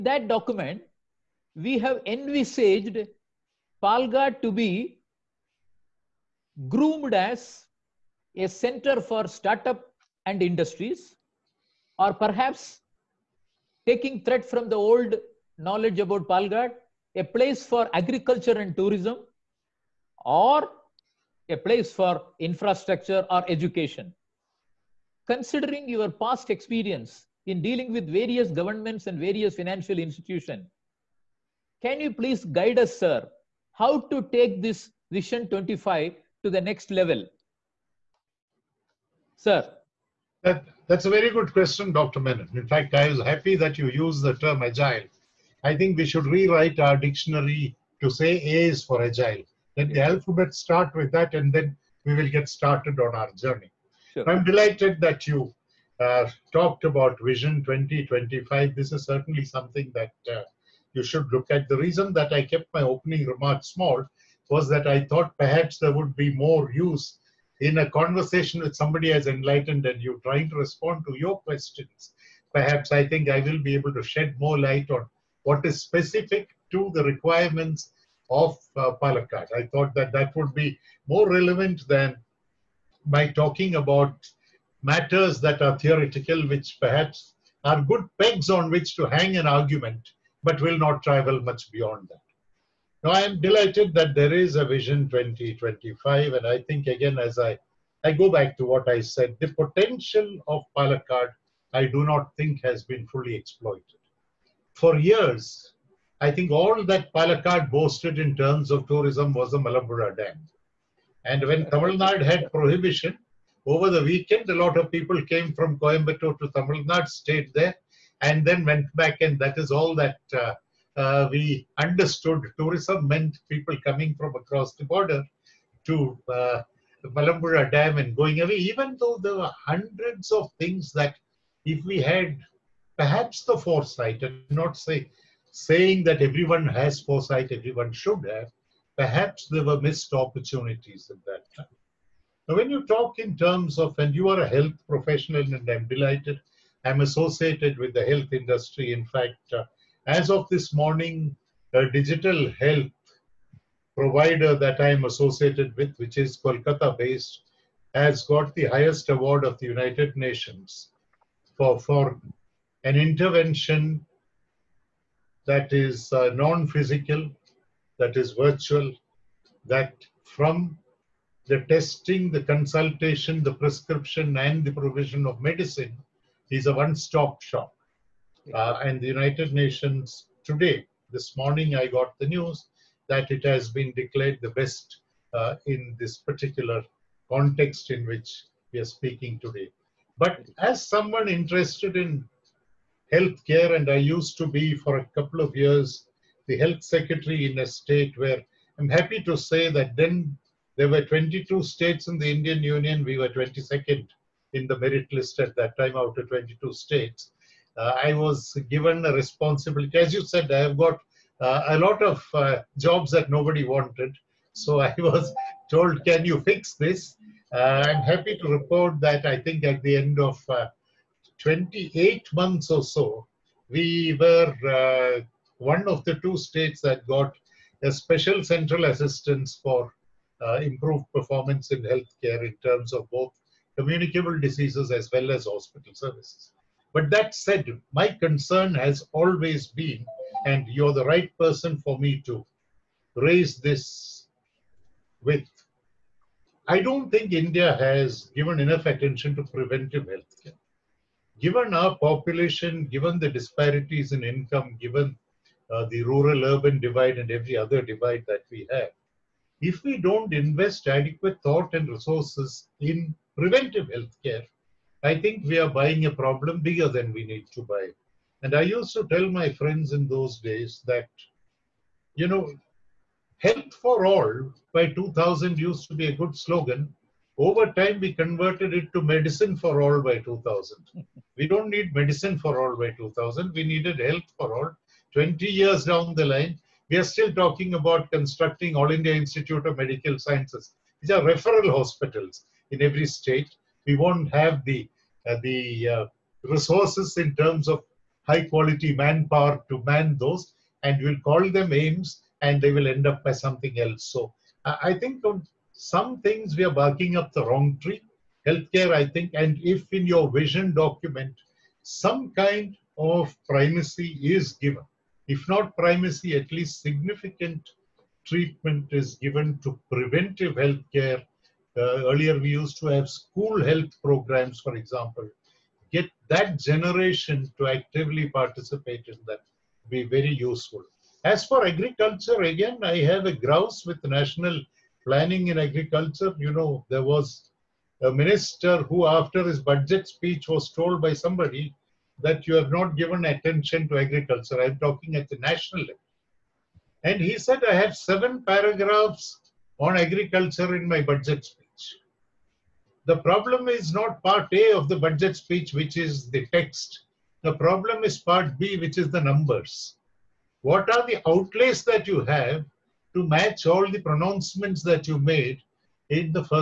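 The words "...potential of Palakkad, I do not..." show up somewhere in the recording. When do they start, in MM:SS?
01:39.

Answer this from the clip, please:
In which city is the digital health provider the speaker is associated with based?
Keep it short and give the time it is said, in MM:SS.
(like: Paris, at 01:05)
Kolkata, at 02:36.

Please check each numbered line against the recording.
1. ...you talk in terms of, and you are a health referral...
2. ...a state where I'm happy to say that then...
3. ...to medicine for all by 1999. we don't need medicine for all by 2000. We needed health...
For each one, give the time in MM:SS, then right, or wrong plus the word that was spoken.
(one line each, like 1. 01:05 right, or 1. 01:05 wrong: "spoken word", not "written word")
1. 02:22 wrong: "professional", not "referral"
2. 03:17 right
3. 04:38 wrong: "2000", not "1999".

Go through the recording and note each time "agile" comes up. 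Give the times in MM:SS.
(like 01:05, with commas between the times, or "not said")
00:44, 00:49.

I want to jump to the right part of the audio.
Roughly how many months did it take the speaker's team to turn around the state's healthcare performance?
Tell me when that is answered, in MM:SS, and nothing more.
03:41.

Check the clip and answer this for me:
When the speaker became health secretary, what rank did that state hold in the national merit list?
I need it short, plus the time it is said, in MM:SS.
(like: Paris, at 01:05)
22nd, at 03:23.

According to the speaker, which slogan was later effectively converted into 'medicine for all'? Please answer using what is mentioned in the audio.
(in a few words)
health for all by 2000.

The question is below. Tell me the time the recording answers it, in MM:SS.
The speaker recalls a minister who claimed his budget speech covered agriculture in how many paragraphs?
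05:47.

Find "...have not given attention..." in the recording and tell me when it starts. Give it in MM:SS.
05:42.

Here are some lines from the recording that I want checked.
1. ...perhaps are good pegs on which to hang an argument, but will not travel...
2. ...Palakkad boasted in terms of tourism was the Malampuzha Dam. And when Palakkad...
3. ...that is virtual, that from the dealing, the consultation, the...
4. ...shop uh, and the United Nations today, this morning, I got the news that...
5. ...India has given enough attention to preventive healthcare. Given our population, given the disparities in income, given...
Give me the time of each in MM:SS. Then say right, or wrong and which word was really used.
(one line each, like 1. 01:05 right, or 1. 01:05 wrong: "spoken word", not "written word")
1. 01:26 right
2. 01:47 wrong: "Tamil", not "Palakkad"
3. 02:47 wrong: "testing", not "dealing"
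4. 02:57 right
5. 04:07 right.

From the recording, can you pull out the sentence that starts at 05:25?
Get that generation to actively participate in that be very useful.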